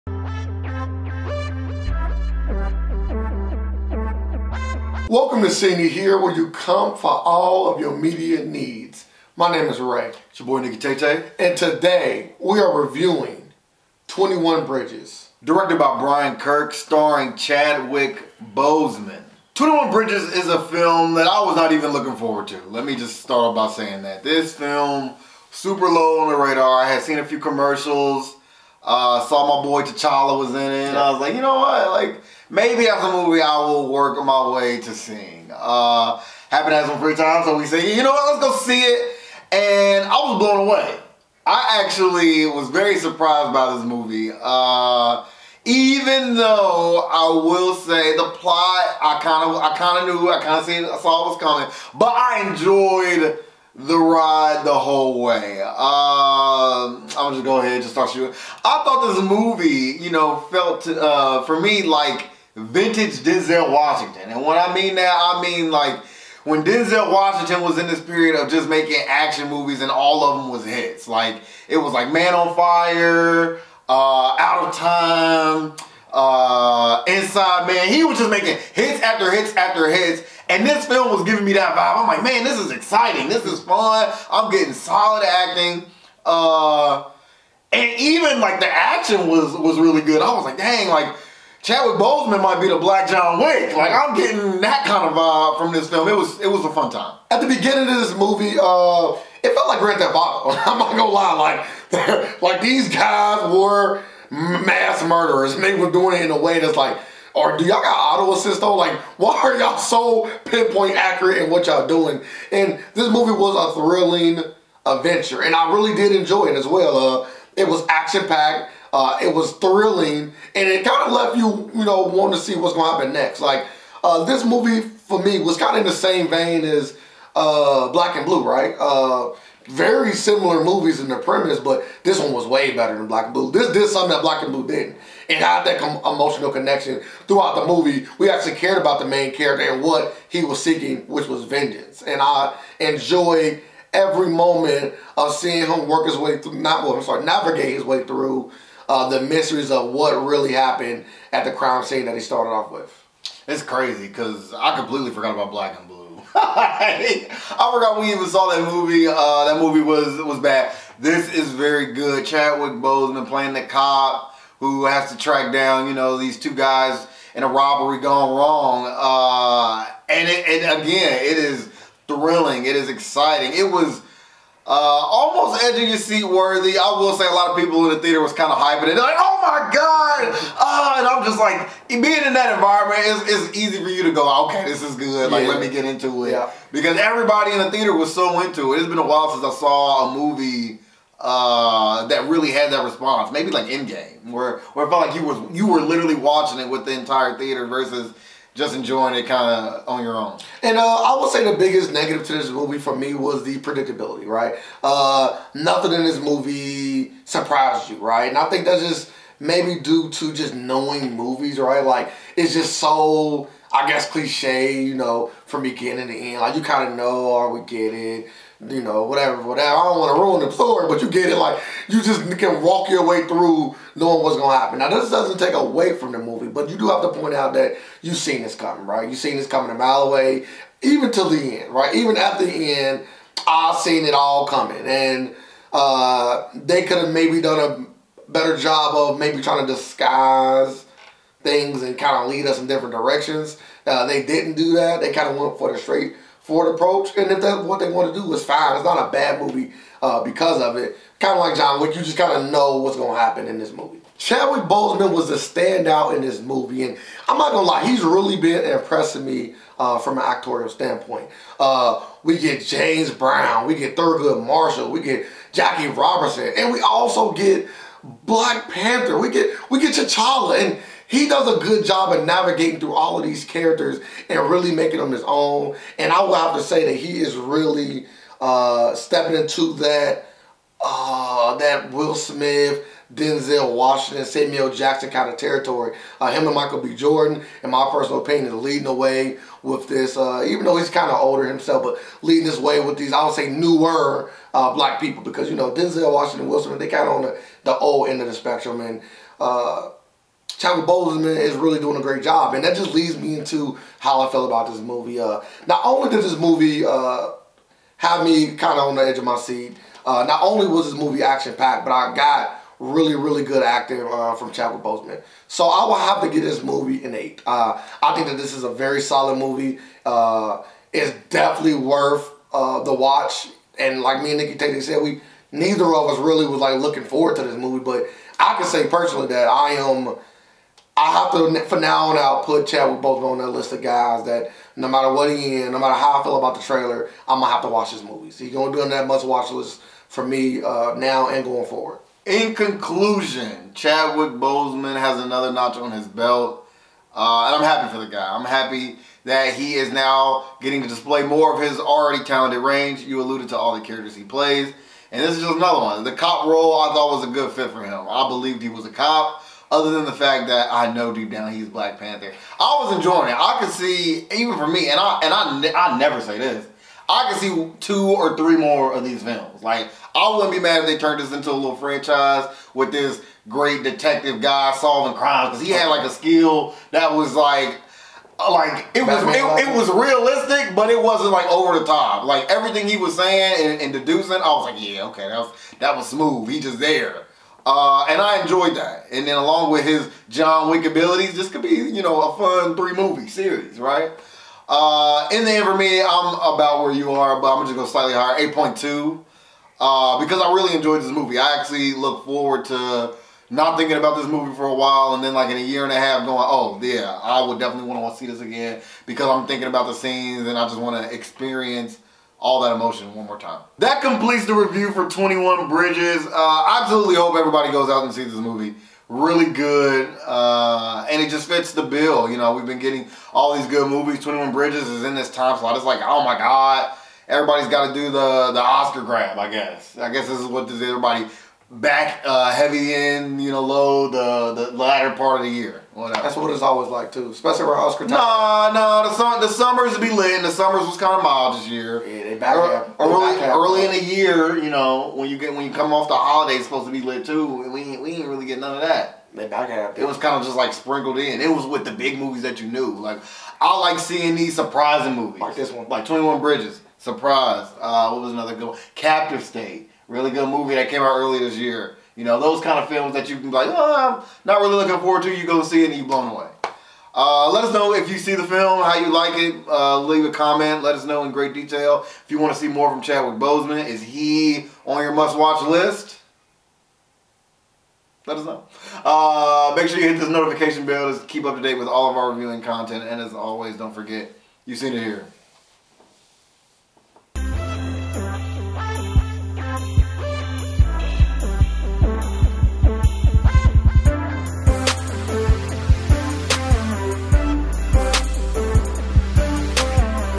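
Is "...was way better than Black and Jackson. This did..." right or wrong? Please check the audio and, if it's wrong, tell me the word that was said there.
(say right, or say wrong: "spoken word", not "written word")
wrong: "Blue", not "Jackson".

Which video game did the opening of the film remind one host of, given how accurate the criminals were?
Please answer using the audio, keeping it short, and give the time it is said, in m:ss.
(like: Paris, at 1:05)
Grand Theft Auto, at 1:39.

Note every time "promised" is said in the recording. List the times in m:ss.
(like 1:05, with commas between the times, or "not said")
not said.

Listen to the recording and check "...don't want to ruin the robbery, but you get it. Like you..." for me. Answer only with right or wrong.
wrong.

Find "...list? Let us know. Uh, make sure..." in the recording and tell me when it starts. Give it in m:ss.
7:55.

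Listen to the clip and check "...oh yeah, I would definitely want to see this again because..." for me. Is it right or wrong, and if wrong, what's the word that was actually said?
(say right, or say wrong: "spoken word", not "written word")
right.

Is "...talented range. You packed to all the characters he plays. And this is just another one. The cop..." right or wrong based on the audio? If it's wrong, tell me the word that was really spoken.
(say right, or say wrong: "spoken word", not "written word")
wrong: "alluded", not "packed".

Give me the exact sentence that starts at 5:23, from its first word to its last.
And like me and Nikki Tate said, we neither of us really was like looking forward to this movie.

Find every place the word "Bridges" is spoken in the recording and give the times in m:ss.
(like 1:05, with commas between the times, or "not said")
0:14, 0:19, 6:55, 7:04, 7:36.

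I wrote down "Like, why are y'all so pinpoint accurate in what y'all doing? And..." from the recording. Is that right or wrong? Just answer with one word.
right.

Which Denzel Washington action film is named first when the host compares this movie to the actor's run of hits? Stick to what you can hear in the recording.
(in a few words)
Man on Fire.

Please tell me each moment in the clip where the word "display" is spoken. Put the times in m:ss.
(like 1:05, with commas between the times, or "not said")
5:50.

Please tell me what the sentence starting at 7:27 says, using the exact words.
we we didn't really get none of that.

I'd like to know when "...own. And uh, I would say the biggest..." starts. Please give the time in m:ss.
3:20.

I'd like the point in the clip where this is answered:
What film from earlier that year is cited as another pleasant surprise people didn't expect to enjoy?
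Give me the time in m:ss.
7:38.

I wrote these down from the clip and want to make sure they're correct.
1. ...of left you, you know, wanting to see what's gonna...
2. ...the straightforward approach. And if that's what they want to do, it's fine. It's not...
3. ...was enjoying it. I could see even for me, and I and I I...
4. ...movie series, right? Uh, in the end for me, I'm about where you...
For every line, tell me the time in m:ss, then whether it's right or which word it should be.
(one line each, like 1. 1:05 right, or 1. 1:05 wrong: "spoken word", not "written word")
1. 2:01 right
2. 4:05 right
3. 6:02 right
4. 6:32 right.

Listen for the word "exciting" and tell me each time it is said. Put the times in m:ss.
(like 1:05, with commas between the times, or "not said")
1:22, 2:52.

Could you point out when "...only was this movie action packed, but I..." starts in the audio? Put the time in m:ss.
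5:10.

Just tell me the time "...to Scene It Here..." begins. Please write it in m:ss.
0:05.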